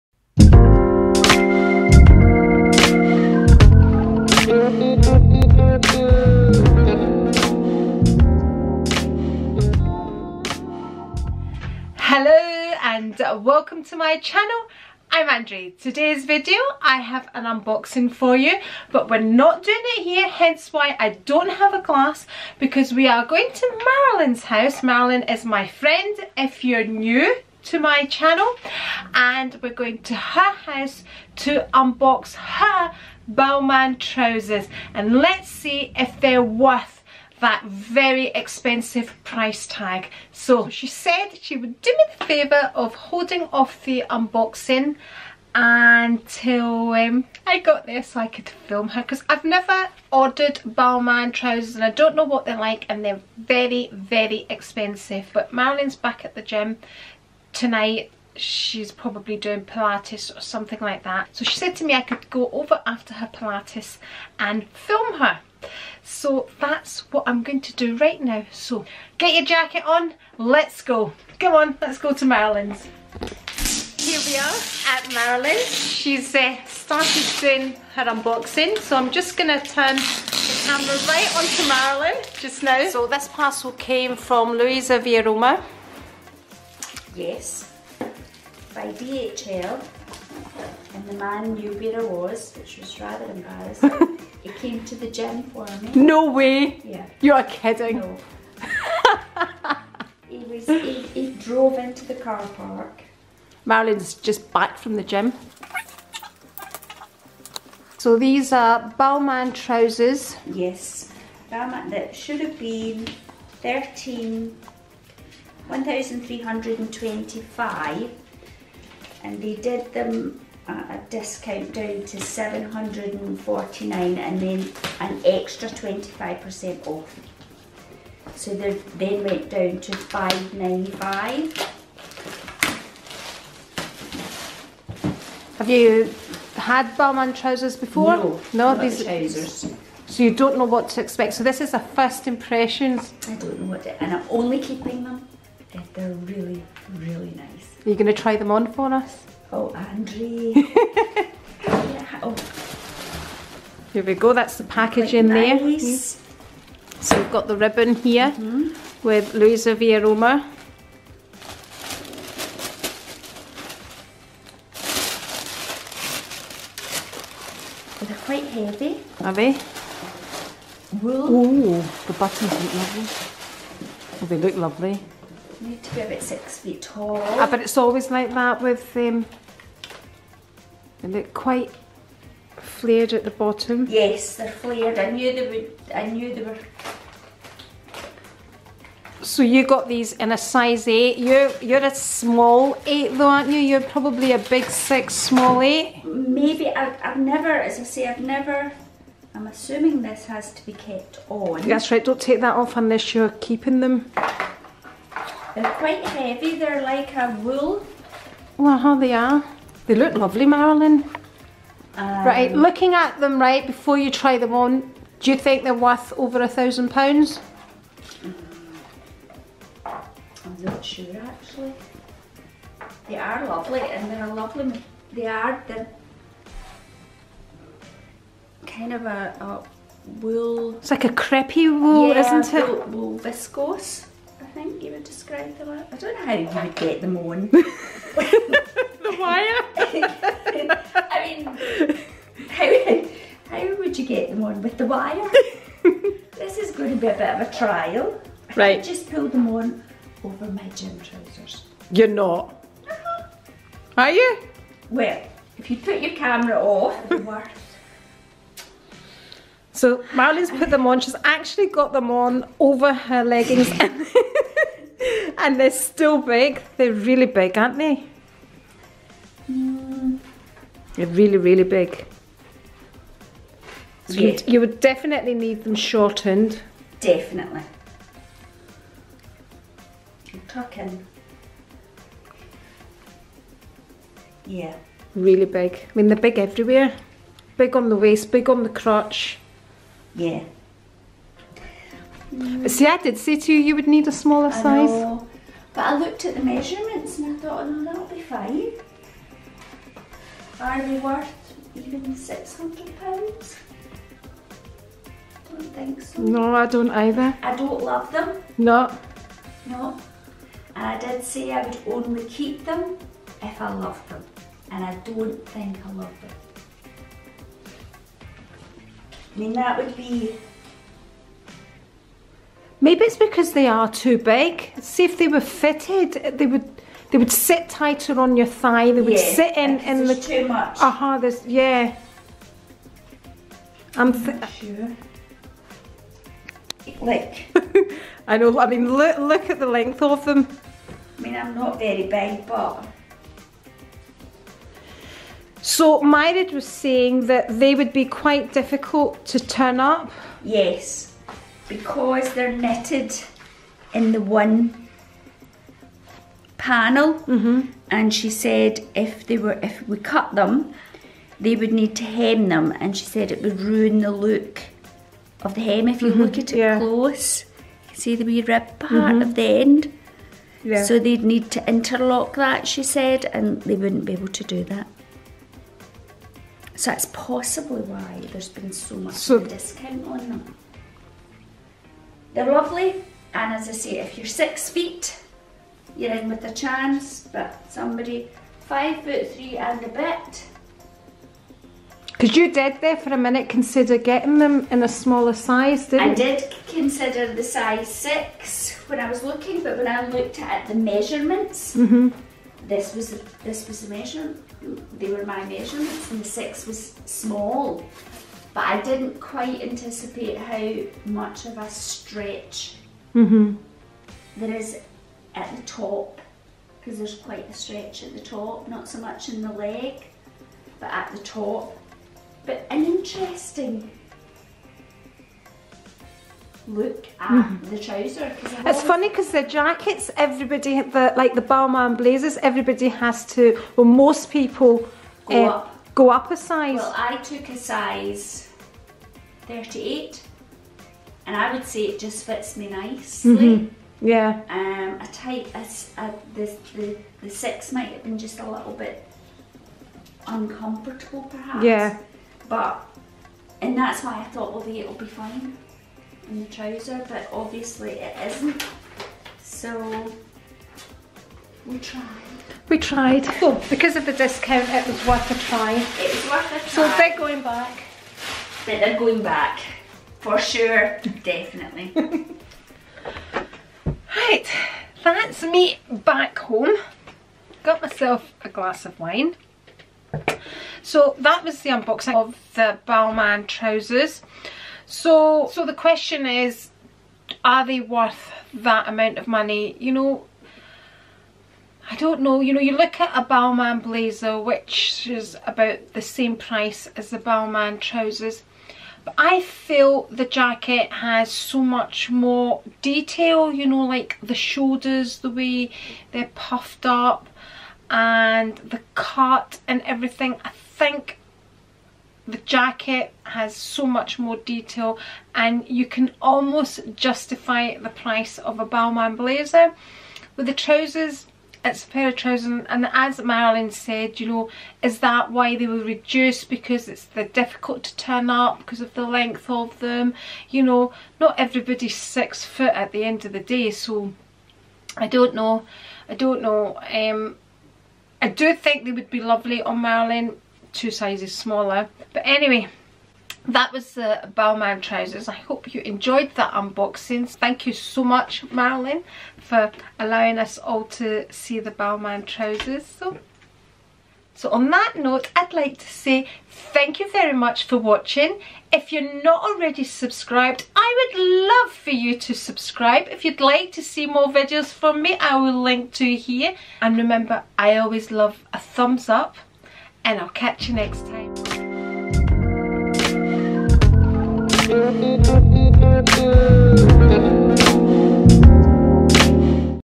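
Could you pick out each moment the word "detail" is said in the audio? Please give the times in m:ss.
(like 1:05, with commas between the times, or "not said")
8:22, 8:34.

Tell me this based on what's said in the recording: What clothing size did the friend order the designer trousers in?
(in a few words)
Size 8.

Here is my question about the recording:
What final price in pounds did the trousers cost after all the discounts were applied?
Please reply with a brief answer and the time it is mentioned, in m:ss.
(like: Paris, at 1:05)
595, at 2:09.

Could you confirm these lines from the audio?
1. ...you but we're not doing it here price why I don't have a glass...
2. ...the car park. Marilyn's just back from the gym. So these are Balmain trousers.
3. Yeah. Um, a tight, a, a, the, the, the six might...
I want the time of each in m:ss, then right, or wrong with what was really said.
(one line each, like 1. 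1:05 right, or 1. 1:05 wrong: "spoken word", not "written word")
1. 0:18 wrong: "hence", not "price"
2. 1:42 right
3. 7:24 right.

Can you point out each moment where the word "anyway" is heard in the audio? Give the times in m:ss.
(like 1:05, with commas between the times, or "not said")
9:02.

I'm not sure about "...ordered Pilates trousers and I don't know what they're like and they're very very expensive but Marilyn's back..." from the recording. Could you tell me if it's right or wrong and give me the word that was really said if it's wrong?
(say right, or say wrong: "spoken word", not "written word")
wrong: "Balmain", not "Pilates".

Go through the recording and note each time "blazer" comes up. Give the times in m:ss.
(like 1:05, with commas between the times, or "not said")
7:11, 8:13, 8:39.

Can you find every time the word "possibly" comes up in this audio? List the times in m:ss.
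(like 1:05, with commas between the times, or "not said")
6:17.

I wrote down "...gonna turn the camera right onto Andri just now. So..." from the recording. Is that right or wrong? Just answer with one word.
wrong.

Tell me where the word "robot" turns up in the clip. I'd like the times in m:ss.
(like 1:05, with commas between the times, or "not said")
not said.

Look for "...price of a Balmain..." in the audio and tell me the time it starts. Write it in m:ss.
8:37.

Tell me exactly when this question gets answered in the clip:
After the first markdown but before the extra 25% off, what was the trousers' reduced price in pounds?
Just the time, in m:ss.
2:02.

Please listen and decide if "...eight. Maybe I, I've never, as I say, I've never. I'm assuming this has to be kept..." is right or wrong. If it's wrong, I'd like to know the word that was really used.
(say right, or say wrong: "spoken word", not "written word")
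right.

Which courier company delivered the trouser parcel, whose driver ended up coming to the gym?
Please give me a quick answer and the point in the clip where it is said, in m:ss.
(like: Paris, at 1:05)
DHL, at 1:28.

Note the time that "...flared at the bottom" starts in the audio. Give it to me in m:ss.
3:02.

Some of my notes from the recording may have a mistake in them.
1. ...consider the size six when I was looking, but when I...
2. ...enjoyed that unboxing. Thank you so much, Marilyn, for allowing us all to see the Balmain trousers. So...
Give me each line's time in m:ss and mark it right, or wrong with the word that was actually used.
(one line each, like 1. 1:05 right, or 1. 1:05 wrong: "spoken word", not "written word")
1. 6:36 right
2. 9:05 right.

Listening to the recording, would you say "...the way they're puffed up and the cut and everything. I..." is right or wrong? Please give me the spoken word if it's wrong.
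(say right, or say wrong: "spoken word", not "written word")
right.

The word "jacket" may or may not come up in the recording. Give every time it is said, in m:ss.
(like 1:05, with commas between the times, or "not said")
1:09, 7:09, 8:20, 8:32.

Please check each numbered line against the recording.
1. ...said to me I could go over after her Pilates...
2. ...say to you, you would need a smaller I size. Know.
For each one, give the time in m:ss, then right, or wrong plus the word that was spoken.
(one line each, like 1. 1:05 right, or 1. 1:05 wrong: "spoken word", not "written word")
1. 1:01 right
2. 4:53 right.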